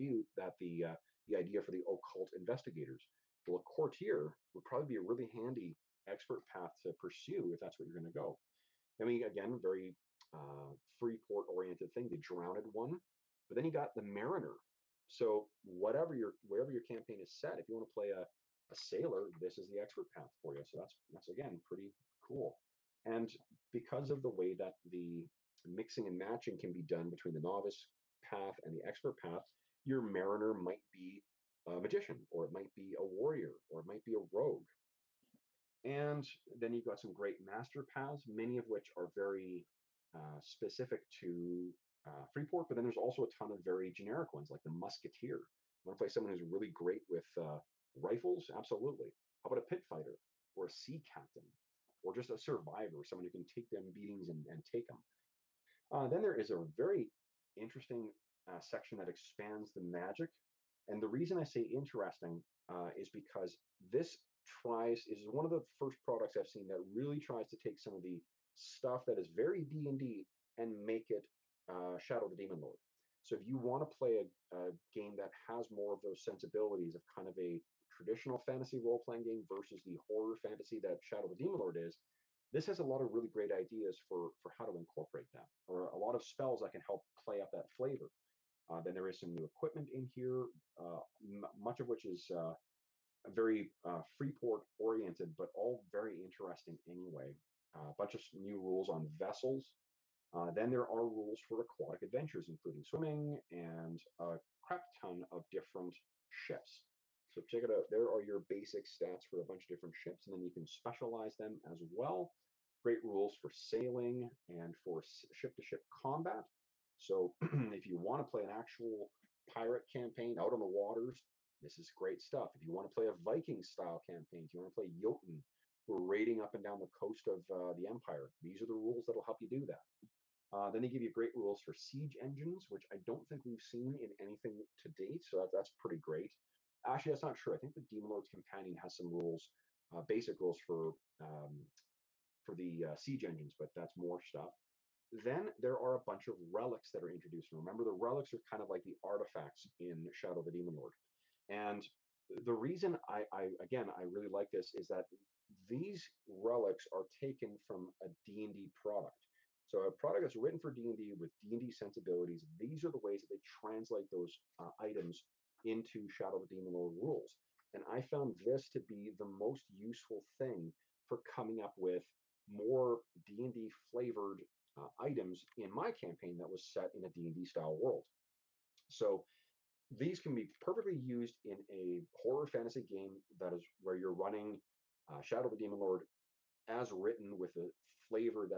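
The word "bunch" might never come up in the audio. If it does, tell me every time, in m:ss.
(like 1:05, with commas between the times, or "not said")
1:37, 1:49, 2:26.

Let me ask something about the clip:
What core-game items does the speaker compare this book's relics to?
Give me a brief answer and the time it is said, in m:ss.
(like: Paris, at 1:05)
Artifacts, at 2:29.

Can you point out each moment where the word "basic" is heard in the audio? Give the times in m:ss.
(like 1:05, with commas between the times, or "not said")
1:48, 2:20.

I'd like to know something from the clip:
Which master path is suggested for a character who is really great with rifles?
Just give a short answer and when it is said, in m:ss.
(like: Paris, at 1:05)
Musketeer, at 0:44.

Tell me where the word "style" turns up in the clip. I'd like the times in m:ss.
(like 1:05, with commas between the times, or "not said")
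2:03, 2:57.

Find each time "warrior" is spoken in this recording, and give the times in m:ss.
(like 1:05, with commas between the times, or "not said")
0:33.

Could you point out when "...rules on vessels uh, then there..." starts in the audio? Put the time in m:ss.
1:38.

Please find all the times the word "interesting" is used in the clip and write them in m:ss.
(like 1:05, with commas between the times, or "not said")
0:57, 1:01, 1:36.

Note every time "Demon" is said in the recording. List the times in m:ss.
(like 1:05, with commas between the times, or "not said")
1:12, 1:21, 2:17, 2:30, 2:46, 3:05.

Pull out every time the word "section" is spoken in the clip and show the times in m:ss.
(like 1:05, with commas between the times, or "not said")
0:58.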